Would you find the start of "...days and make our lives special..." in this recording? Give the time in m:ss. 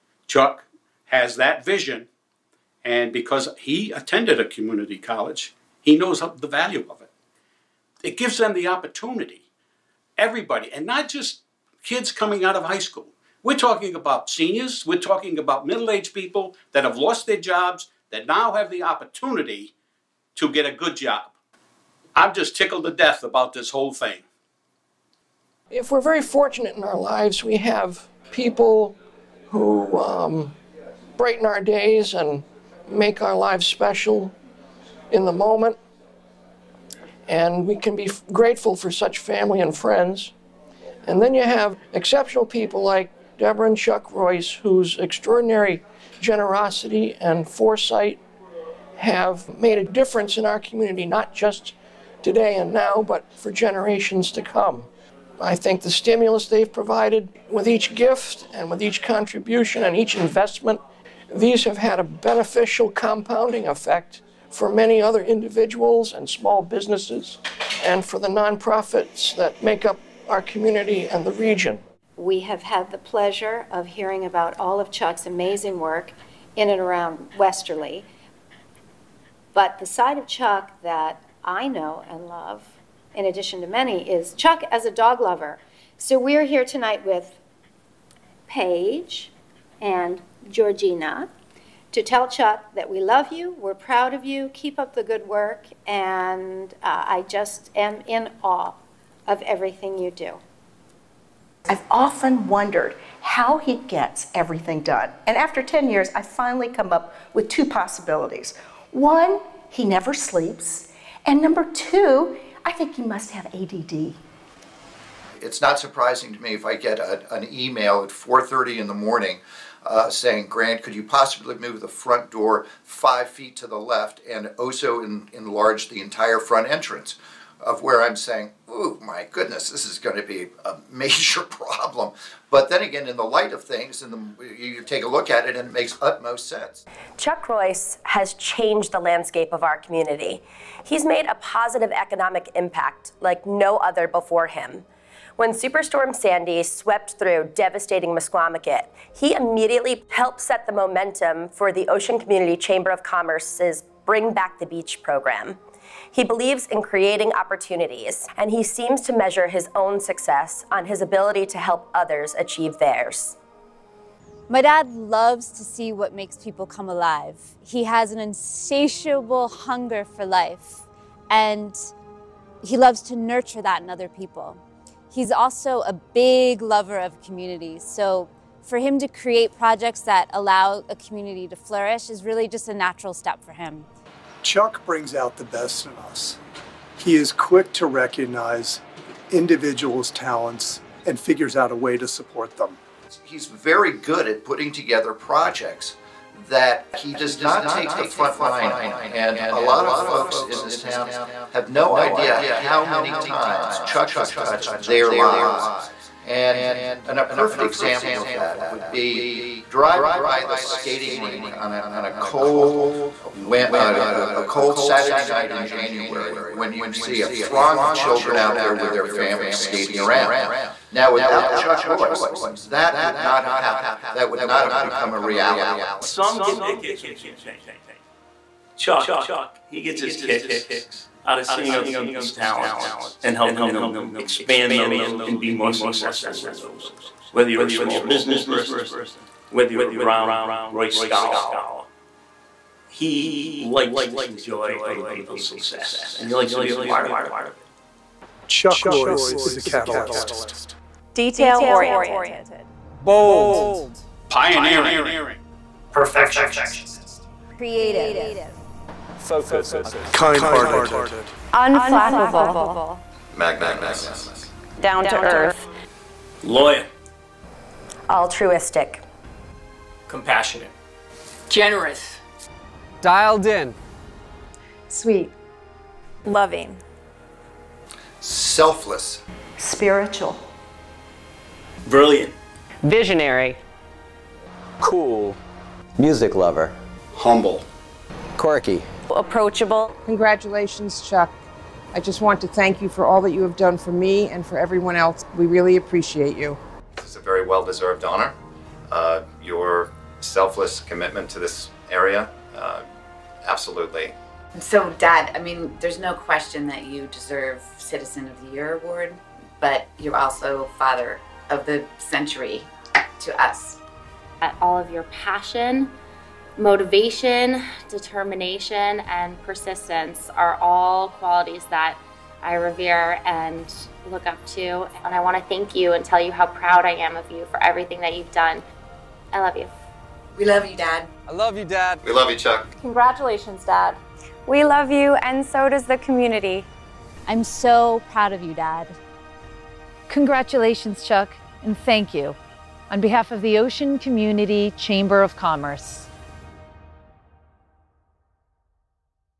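0:31.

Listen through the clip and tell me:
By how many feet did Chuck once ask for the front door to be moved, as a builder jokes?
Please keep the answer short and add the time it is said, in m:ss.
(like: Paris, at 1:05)
5 feet, at 2:02.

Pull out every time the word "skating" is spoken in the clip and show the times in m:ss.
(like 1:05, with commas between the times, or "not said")
3:30, 3:39.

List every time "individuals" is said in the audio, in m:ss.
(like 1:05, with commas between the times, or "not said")
1:05, 3:09.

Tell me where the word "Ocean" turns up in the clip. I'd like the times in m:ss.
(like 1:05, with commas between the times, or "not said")
2:31, 5:43.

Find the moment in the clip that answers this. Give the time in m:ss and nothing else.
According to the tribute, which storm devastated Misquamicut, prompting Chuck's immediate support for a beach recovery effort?
2:25.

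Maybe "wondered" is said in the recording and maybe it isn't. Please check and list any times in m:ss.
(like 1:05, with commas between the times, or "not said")
1:42.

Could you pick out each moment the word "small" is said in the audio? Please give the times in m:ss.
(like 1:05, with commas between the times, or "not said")
1:06, 3:57.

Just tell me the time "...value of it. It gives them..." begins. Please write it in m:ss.
0:06.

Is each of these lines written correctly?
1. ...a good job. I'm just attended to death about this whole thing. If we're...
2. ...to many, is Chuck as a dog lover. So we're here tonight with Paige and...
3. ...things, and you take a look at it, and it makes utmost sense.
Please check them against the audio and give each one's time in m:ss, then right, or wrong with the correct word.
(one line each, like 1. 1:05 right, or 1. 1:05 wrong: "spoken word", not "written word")
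1. 0:20 wrong: "tickled", not "attended"
2. 1:23 right
3. 2:13 right.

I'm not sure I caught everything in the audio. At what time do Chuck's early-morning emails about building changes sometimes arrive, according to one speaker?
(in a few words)
4:30.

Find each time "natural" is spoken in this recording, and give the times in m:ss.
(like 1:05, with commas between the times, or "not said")
3:02.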